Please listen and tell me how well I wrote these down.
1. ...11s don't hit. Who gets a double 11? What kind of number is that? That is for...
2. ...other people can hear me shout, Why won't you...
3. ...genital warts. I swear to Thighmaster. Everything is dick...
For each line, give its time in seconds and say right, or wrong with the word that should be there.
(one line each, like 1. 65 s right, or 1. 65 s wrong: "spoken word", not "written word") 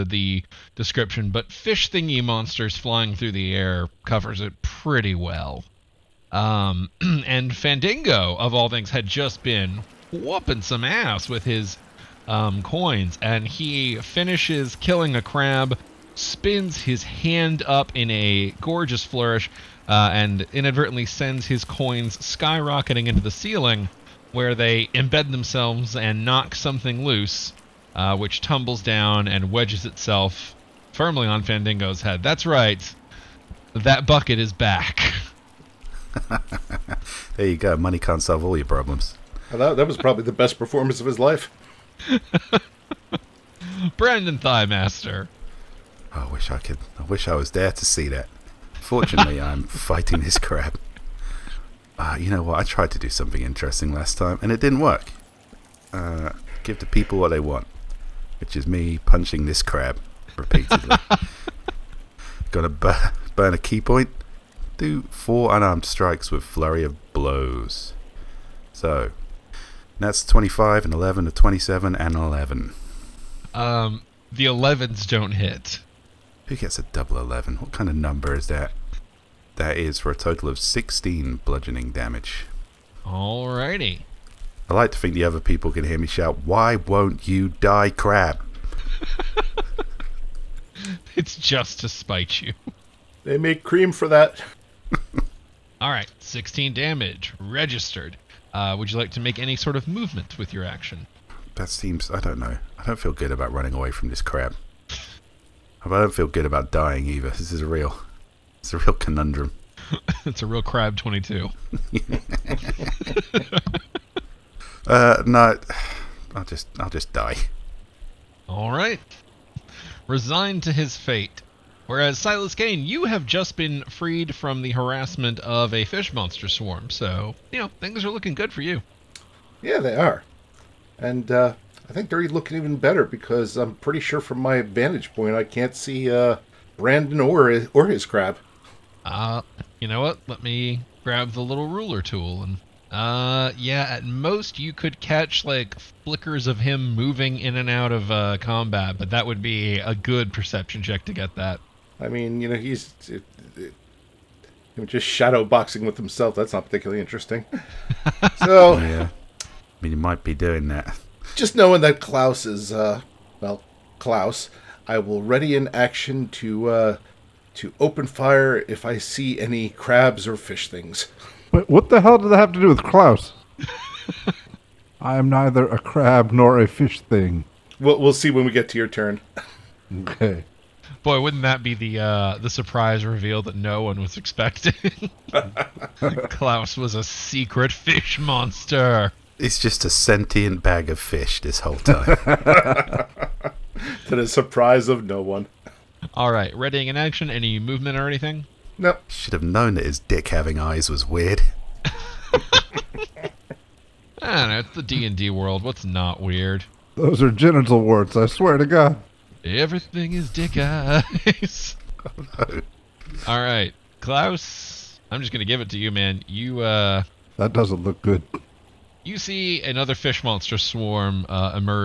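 1. 74 s right
2. 85 s right
3. 207 s wrong: "God", not "Thighmaster".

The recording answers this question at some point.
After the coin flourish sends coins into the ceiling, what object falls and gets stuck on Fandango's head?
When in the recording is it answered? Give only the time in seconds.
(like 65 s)
34 s.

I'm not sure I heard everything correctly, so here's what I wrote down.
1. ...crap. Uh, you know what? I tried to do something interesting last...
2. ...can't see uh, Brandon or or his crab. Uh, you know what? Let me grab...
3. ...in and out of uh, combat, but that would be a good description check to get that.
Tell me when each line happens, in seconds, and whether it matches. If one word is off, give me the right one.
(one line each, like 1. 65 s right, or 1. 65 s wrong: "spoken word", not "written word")
1. 50 s right
2. 135 s right
3. 147 s wrong: "perception", not "description".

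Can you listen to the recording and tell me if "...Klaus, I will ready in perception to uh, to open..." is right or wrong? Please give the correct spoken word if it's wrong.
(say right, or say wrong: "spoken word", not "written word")
wrong: "action", not "perception".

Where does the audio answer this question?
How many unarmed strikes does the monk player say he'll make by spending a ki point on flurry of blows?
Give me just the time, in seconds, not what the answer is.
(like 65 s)
65 s.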